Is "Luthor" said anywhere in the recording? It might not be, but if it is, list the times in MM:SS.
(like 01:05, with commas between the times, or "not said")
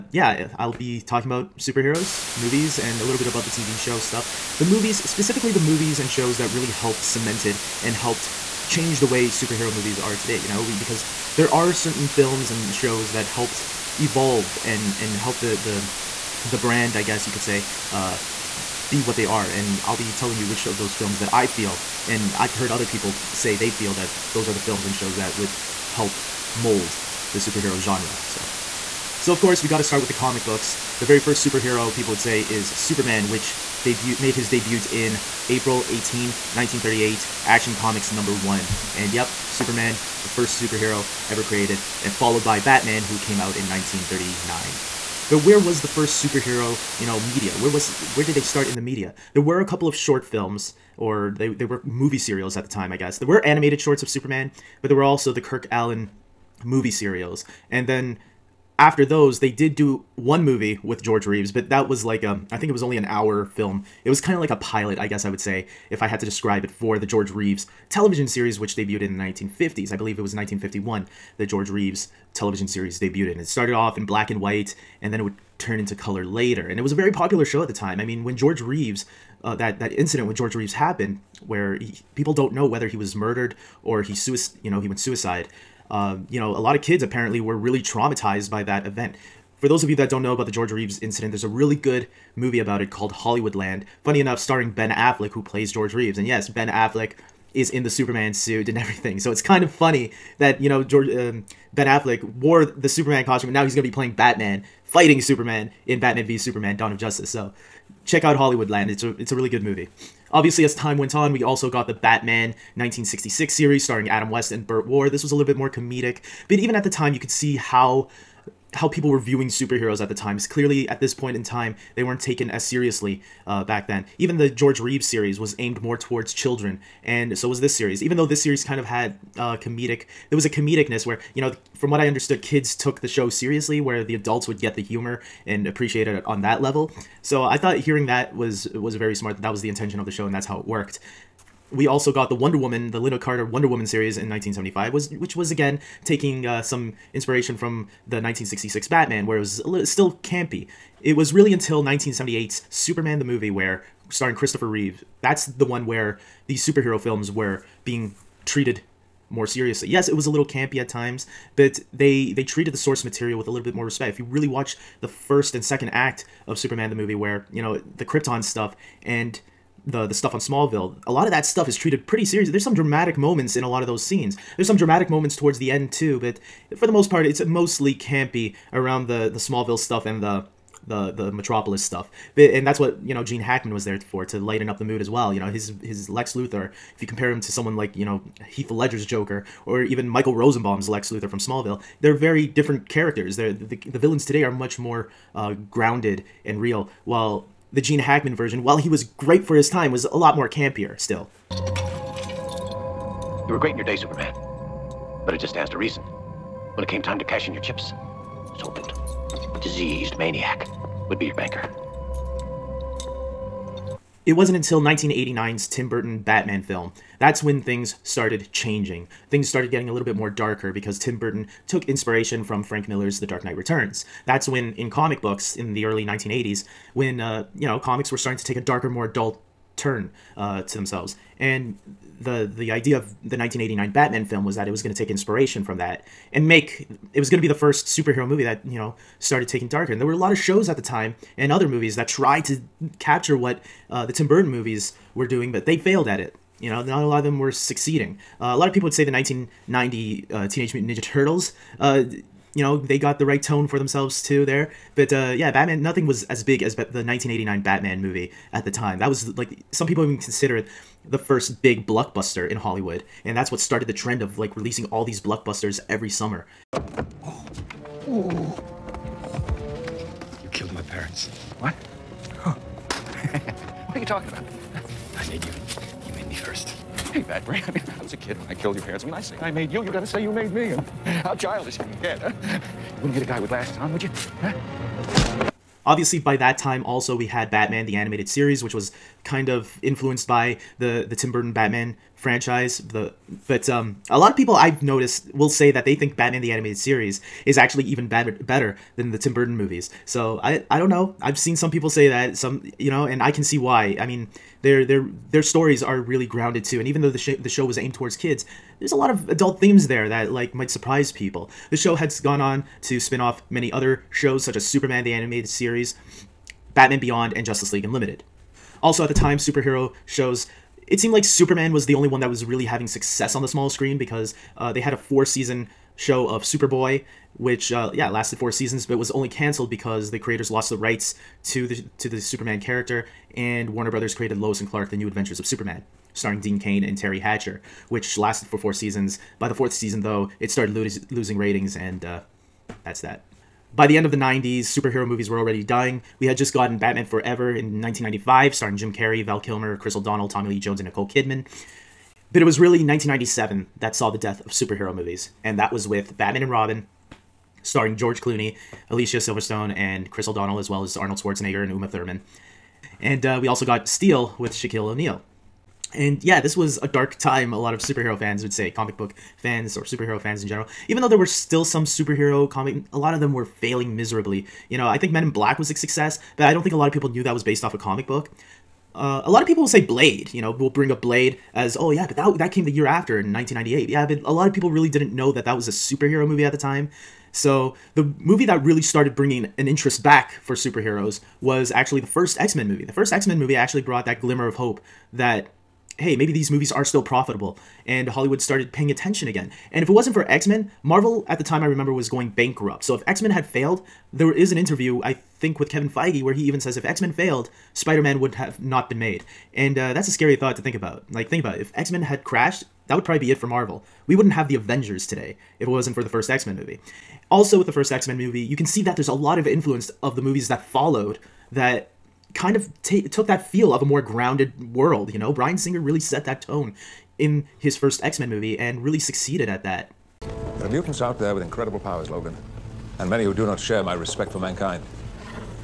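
03:06, 03:11.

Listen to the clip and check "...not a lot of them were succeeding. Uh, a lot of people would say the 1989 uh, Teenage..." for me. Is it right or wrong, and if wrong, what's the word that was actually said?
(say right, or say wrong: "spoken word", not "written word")
wrong: "1990", not "1989".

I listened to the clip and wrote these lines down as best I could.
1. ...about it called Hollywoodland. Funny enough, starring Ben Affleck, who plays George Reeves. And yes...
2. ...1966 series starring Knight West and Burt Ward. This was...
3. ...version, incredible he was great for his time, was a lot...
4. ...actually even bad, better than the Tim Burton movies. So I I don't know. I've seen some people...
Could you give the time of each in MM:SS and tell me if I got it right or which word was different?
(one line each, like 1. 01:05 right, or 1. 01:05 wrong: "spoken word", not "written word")
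1. 01:32 right
2. 01:52 wrong: "Adam", not "Knight"
3. 03:18 wrong: "while", not "incredible"
4. 04:57 right.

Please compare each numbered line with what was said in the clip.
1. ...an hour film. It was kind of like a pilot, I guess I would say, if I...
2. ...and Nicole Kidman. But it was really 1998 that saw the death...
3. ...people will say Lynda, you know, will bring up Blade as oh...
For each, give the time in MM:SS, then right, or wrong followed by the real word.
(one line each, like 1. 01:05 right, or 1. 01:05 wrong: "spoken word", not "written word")
1. 01:02 right
2. 05:50 wrong: "1997", not "1998"
3. 06:19 wrong: "Blade", not "Lynda".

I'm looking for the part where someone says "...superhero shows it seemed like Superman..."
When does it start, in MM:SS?
05:19.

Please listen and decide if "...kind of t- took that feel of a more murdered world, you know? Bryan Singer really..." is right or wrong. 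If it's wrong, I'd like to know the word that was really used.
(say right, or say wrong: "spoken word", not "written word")
wrong: "grounded", not "murdered".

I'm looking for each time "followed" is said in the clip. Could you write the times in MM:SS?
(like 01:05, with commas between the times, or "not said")
00:42, 07:00.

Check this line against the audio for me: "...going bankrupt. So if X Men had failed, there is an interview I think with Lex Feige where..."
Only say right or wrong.
wrong.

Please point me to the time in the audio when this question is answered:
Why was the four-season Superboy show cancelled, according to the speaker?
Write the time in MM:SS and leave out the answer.
05:30.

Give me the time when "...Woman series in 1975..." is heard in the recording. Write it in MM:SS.
02:23.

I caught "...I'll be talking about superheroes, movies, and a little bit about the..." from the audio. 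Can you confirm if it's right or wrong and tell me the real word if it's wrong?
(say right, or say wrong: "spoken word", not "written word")
right.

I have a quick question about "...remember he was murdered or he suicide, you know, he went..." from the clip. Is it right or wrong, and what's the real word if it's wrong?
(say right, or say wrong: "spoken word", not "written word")
wrong: "whether", not "remember".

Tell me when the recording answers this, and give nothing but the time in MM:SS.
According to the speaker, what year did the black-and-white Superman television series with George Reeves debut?
01:10.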